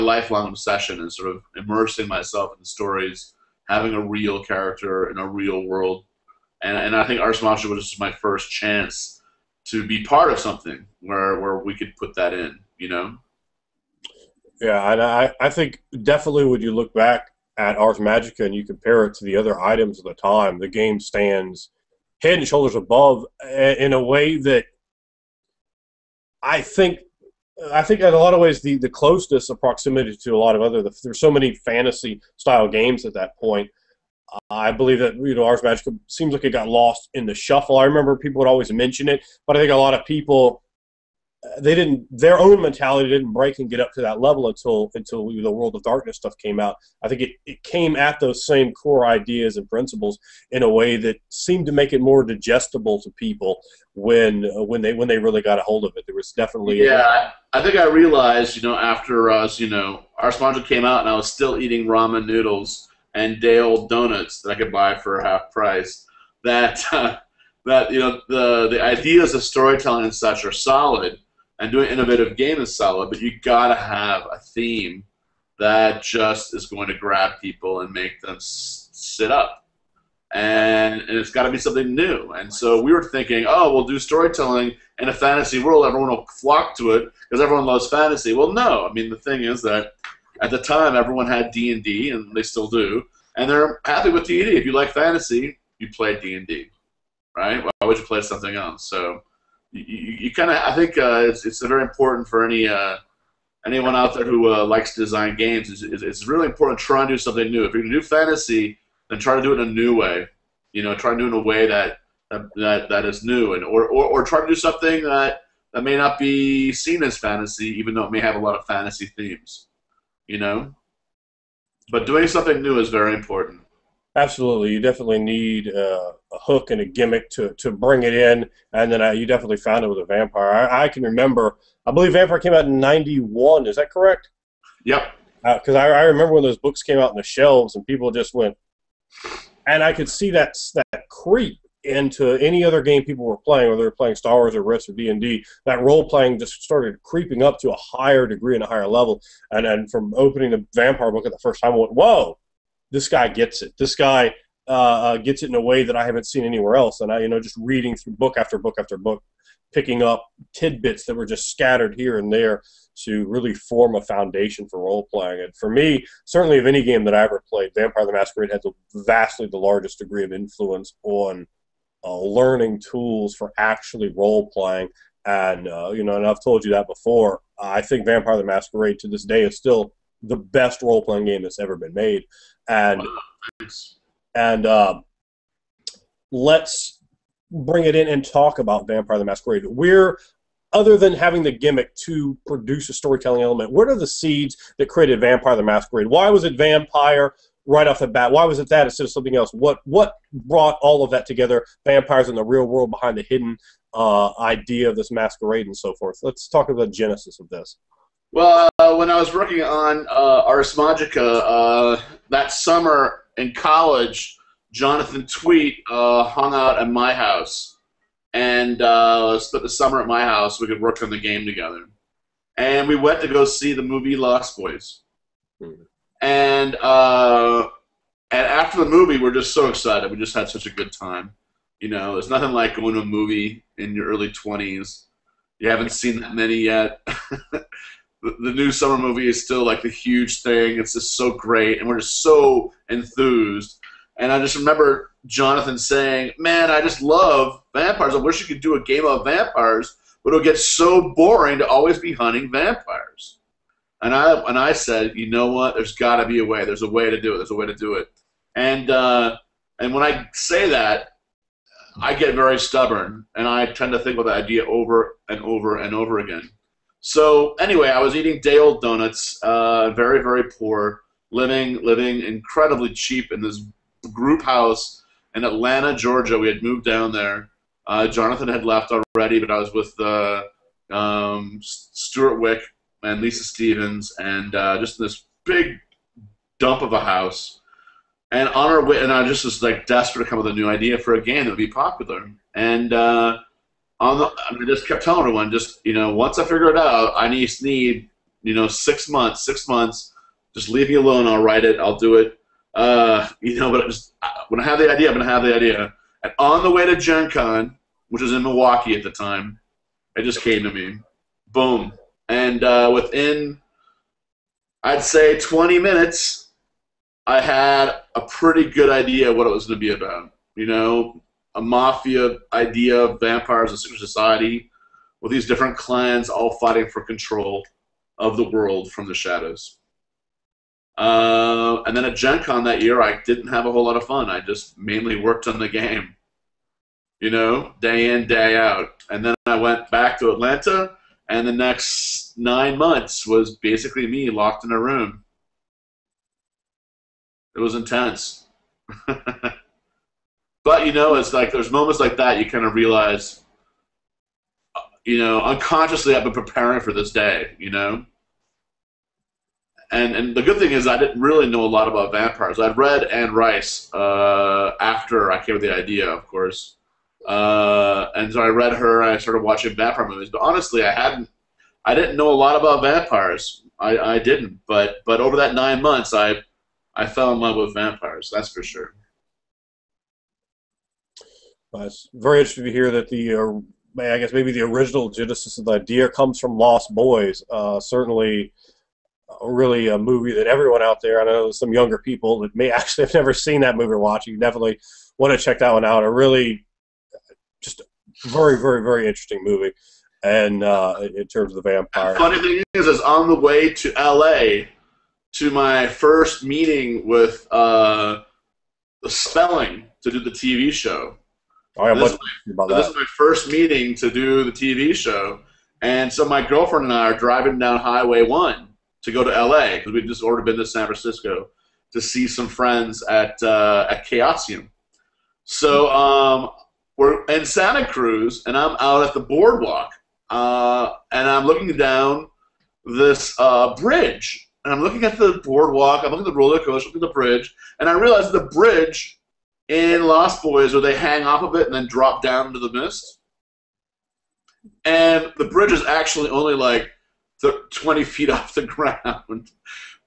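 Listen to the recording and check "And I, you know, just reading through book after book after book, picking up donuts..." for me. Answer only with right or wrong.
wrong.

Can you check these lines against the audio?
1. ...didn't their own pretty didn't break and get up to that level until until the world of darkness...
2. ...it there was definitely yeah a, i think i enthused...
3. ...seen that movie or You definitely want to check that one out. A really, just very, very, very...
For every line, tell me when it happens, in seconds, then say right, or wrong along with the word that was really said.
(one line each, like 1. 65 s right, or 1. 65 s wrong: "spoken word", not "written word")
1. 41 s wrong: "mentality", not "pretty"
2. 55 s wrong: "realized", not "enthused"
3. 393 s right.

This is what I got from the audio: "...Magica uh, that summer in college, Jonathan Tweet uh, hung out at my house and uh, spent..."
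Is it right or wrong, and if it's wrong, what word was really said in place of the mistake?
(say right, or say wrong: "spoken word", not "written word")
right.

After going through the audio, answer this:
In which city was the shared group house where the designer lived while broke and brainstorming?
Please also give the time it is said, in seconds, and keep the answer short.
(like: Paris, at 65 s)
Atlanta, Georgia, at 275 s.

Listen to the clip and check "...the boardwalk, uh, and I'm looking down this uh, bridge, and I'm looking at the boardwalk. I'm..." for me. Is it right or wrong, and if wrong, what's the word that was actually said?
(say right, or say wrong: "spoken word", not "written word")
right.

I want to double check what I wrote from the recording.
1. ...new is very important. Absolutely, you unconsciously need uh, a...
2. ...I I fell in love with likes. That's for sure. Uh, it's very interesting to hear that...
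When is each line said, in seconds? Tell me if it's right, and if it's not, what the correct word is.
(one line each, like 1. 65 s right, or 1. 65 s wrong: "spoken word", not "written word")
1. 122 s wrong: "definitely", not "unconsciously"
2. 376 s wrong: "vampires", not "likes".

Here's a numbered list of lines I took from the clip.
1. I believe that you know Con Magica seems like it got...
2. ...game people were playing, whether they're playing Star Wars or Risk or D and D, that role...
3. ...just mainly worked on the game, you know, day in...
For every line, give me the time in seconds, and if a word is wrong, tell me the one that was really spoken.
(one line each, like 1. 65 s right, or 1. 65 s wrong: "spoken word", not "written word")
1. 34 s wrong: "Ars", not "Con"
2. 142 s right
3. 334 s right.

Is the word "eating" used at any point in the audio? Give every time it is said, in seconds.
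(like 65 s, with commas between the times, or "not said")
61 s, 268 s.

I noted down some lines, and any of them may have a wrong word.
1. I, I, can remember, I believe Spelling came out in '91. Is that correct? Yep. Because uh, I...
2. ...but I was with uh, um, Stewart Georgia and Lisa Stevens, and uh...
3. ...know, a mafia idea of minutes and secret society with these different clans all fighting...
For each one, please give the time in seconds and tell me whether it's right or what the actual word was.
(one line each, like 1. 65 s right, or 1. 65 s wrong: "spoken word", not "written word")
1. 130 s wrong: "Vampire", not "Spelling"
2. 279 s wrong: "Wieck", not "Georgia"
3. 320 s wrong: "vampires", not "minutes".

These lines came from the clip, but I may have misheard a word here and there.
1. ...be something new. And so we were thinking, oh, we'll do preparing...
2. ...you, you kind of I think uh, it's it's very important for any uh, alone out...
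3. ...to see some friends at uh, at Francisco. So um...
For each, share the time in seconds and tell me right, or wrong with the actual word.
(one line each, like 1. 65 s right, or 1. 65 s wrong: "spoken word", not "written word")
1. 81 s wrong: "storytelling", not "preparing"
2. 99 s wrong: "anyone", not "alone"
3. 421 s wrong: "Chaosium", not "Francisco".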